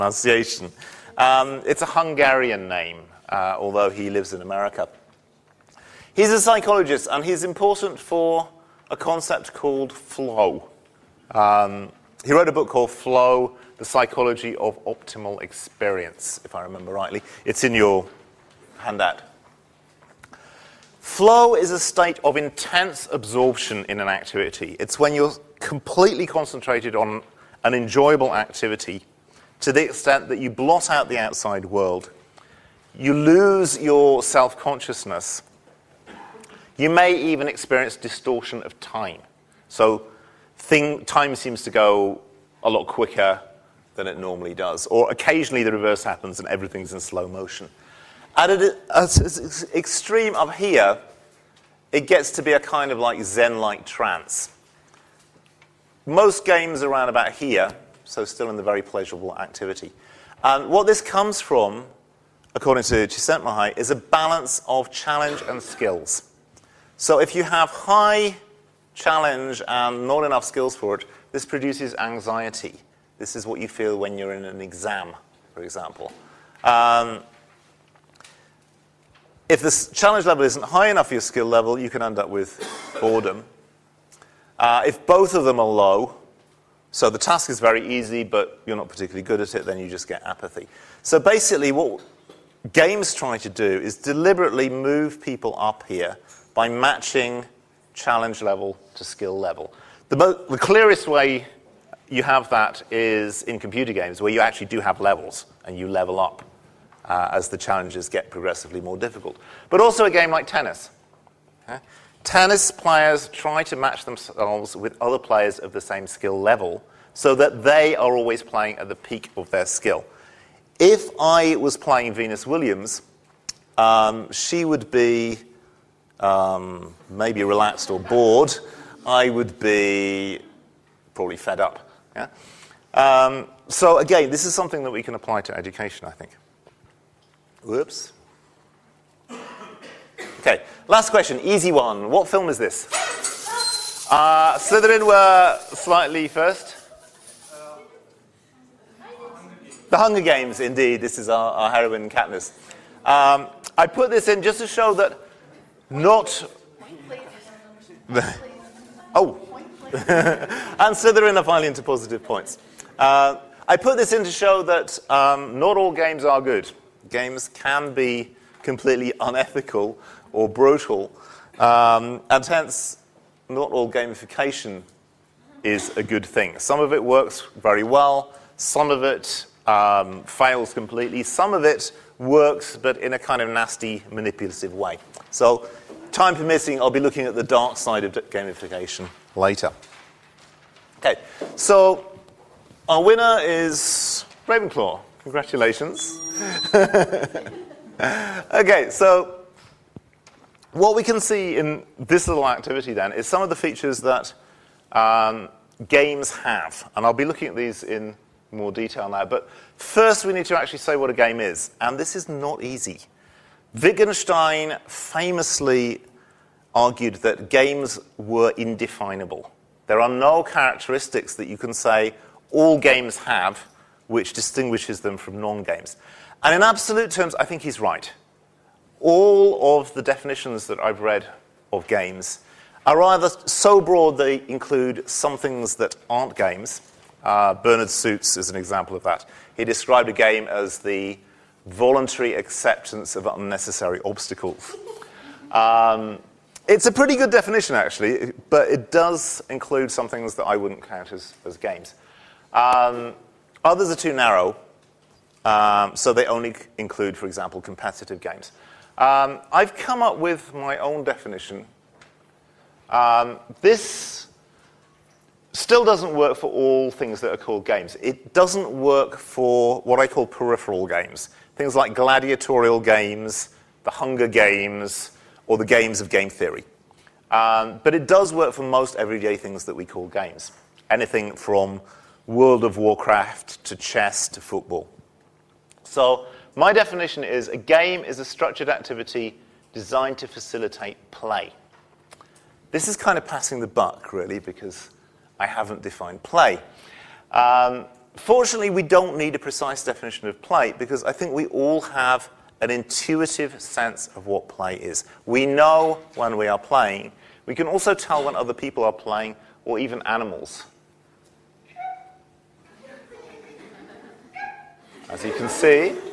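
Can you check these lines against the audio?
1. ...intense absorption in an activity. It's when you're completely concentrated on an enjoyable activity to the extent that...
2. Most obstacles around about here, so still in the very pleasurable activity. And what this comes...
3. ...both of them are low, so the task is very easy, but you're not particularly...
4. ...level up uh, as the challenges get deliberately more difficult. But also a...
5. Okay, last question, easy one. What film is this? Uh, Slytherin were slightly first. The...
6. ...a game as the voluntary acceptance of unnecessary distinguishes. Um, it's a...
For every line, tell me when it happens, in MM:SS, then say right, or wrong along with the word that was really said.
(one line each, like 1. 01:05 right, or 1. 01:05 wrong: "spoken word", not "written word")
1. 00:22 right
2. 00:56 wrong: "games", not "obstacles"
3. 01:25 right
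4. 01:45 wrong: "progressively", not "deliberately"
5. 02:20 right
6. 04:00 wrong: "obstacles", not "distinguishes".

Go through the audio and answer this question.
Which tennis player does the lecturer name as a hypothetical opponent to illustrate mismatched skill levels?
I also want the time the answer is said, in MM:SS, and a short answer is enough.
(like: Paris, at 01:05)
Venus Williams, at 02:02.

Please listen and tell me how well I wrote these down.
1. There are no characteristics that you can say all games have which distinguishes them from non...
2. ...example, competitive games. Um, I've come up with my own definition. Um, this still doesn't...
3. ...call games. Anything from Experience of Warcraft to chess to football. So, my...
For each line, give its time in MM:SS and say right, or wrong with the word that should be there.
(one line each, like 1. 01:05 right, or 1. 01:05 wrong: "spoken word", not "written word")
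1. 03:39 right
2. 04:17 right
3. 04:39 wrong: "World", not "Experience".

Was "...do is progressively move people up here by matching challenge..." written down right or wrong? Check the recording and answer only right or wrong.
wrong.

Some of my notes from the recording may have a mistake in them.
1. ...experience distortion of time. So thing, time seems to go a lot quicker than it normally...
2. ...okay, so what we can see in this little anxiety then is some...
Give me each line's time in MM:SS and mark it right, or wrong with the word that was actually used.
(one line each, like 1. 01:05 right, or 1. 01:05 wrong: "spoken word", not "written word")
1. 00:37 right
2. 03:16 wrong: "activity", not "anxiety".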